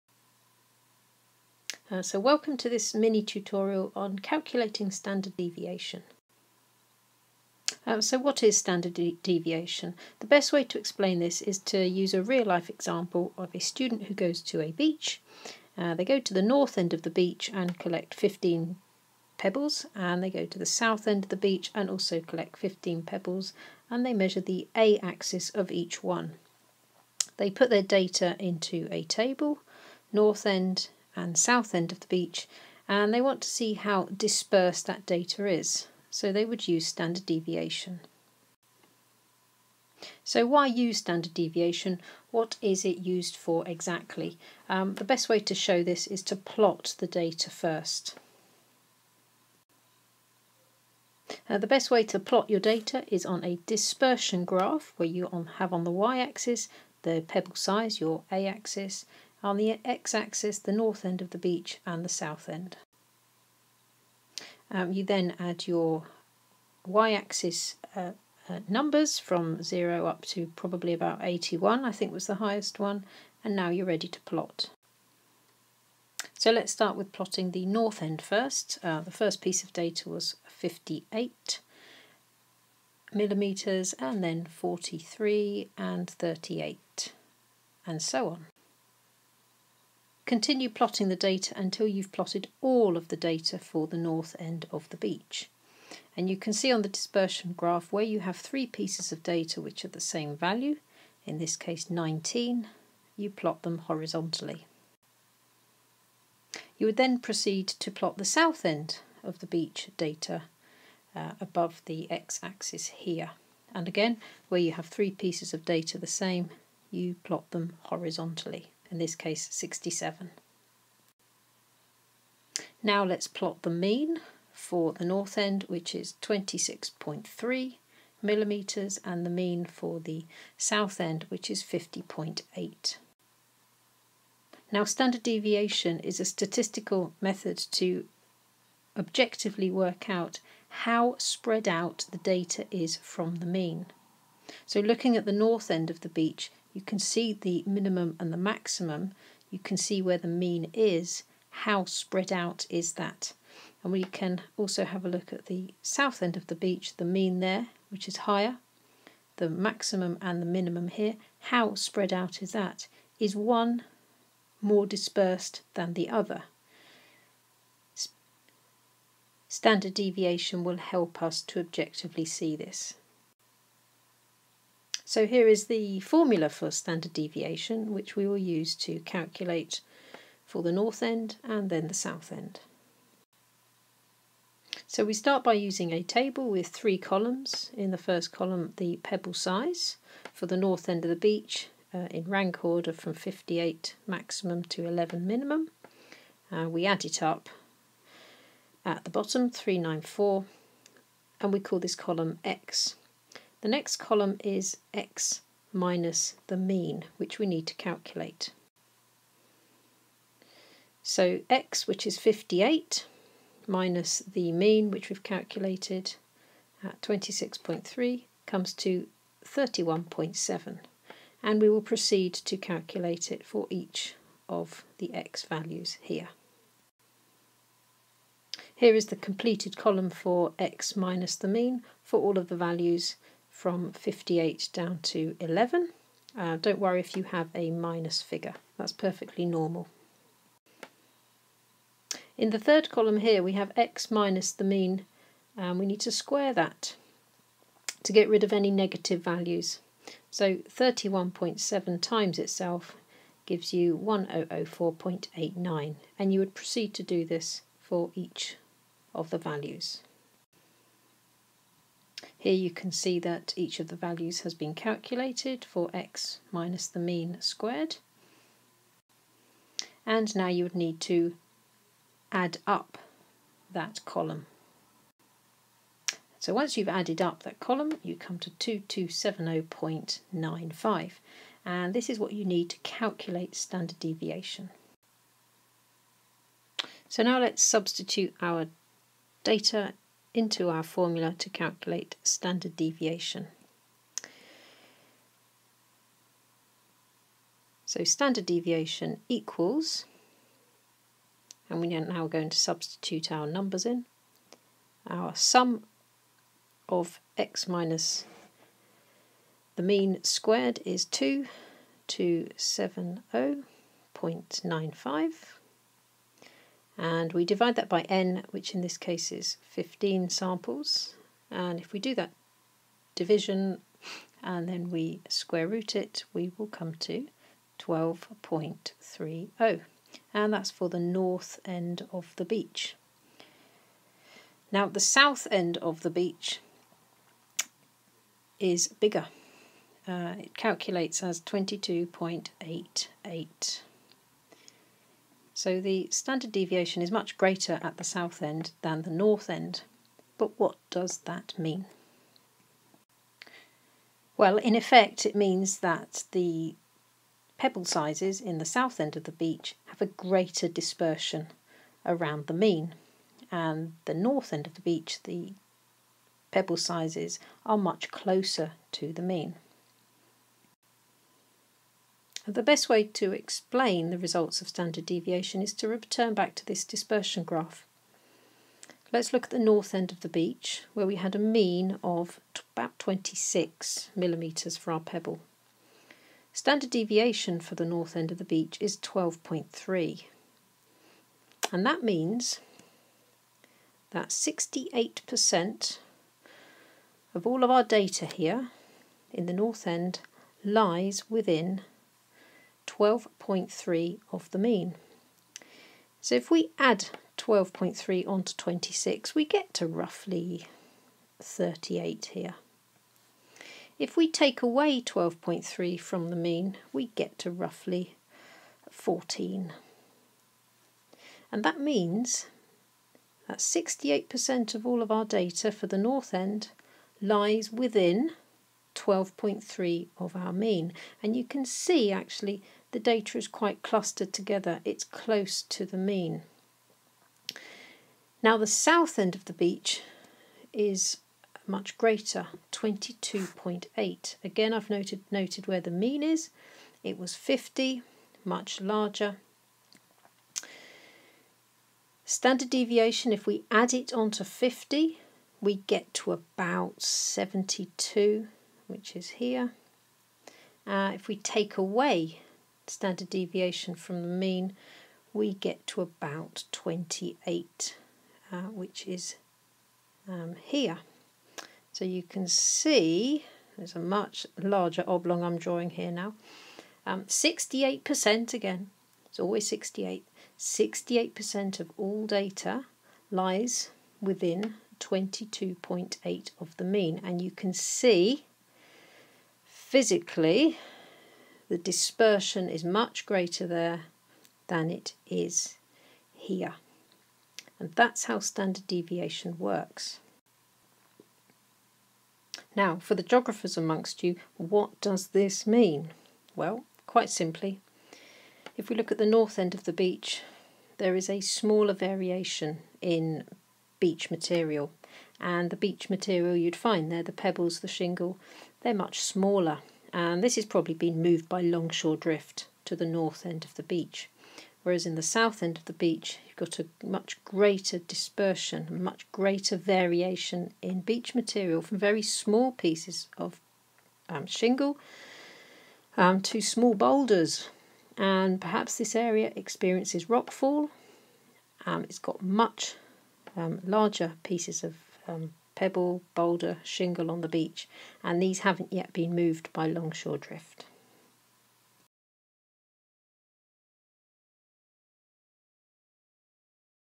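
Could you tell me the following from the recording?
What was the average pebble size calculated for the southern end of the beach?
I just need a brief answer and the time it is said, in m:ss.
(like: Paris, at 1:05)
50.8, at 2:11.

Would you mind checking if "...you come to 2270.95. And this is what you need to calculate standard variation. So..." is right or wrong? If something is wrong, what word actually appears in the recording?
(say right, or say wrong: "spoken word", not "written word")
wrong: "deviation", not "variation".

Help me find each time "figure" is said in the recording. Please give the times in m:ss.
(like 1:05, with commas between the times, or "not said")
3:58.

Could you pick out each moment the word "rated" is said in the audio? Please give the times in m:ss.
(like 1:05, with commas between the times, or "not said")
not said.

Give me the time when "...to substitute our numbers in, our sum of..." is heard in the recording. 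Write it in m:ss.
5:02.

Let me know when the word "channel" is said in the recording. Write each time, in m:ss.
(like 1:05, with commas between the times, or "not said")
not said.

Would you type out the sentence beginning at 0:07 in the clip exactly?
Uh, so what is standard de deviation?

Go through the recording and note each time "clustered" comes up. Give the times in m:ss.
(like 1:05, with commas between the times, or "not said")
7:13.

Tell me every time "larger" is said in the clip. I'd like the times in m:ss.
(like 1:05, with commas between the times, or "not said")
7:28, 7:54, 9:03.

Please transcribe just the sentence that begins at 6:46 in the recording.
So if we add 12.3 onto 26, we get to roughly 38 here.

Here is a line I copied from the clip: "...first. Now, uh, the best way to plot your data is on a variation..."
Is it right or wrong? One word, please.
wrong.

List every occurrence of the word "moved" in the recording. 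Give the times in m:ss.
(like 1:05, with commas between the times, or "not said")
8:41, 9:09.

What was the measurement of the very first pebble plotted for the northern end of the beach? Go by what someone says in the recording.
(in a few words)
58 millimetres.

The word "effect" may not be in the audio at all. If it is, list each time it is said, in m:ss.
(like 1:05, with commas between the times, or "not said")
5:54.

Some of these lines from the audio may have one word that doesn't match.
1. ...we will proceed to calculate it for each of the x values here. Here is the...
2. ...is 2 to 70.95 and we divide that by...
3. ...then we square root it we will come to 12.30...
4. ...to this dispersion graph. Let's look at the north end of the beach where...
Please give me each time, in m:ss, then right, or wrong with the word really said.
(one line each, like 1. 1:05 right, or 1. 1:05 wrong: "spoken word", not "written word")
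1. 3:41 right
2. 5:10 right
3. 5:24 right
4. 6:16 right.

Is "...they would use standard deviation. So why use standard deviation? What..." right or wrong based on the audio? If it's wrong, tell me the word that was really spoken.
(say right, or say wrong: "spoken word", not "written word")
right.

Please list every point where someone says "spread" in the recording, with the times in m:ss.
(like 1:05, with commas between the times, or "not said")
2:21, 2:31, 2:41.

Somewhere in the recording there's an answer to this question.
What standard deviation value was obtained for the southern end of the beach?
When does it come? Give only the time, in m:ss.
5:41.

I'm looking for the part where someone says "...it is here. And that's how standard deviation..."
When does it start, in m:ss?
8:14.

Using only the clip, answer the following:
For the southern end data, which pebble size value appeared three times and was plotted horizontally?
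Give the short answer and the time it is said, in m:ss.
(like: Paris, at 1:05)
67, at 1:59.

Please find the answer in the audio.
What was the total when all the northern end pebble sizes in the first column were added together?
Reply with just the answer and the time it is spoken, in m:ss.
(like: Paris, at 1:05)
394, at 3:19.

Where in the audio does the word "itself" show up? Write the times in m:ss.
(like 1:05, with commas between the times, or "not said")
4:12.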